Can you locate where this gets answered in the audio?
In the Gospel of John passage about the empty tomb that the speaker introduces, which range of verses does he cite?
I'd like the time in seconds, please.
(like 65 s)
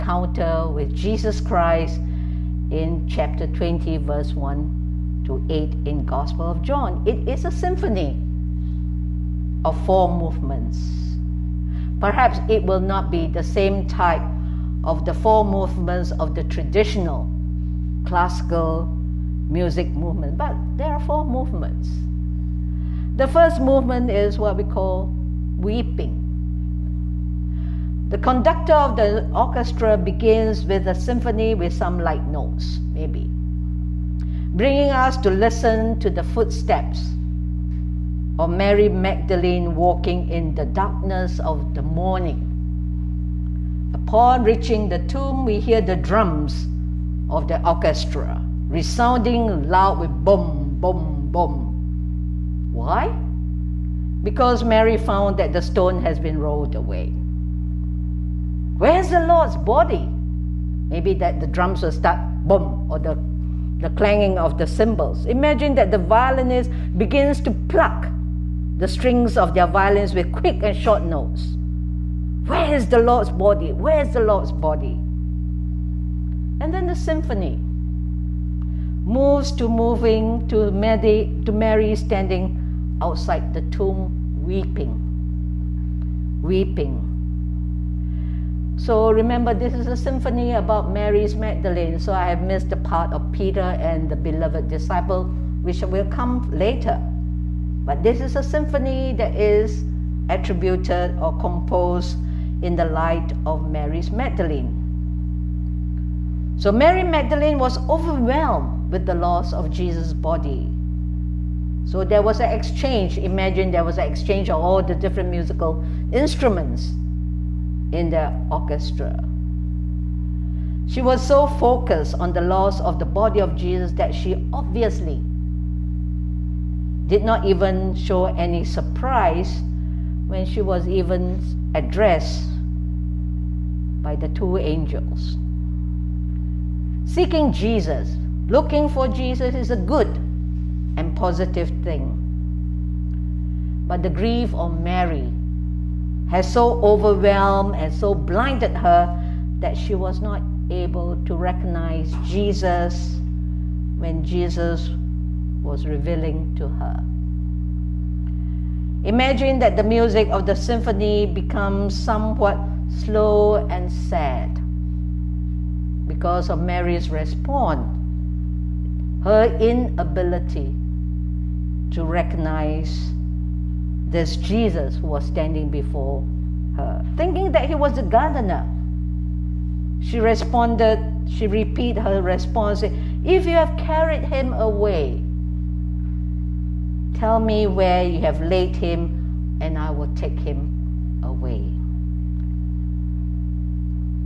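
4 s.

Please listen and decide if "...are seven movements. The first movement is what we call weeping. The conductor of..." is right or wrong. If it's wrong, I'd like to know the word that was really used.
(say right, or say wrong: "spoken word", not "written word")
wrong: "four", not "seven".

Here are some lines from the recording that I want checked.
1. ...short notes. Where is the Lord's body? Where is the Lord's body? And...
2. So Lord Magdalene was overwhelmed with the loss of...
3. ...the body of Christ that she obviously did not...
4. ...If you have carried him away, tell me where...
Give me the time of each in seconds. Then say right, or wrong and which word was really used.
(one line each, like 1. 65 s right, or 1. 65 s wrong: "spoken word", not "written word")
1. 70 s right
2. 106 s wrong: "Mary", not "Lord"
3. 122 s wrong: "Jesus", not "Christ"
4. 183 s right.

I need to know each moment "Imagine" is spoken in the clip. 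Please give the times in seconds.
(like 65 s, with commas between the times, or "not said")
65 s, 113 s, 159 s.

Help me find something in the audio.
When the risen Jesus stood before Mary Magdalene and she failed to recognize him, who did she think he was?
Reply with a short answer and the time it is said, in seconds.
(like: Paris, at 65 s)
a gardener, at 178 s.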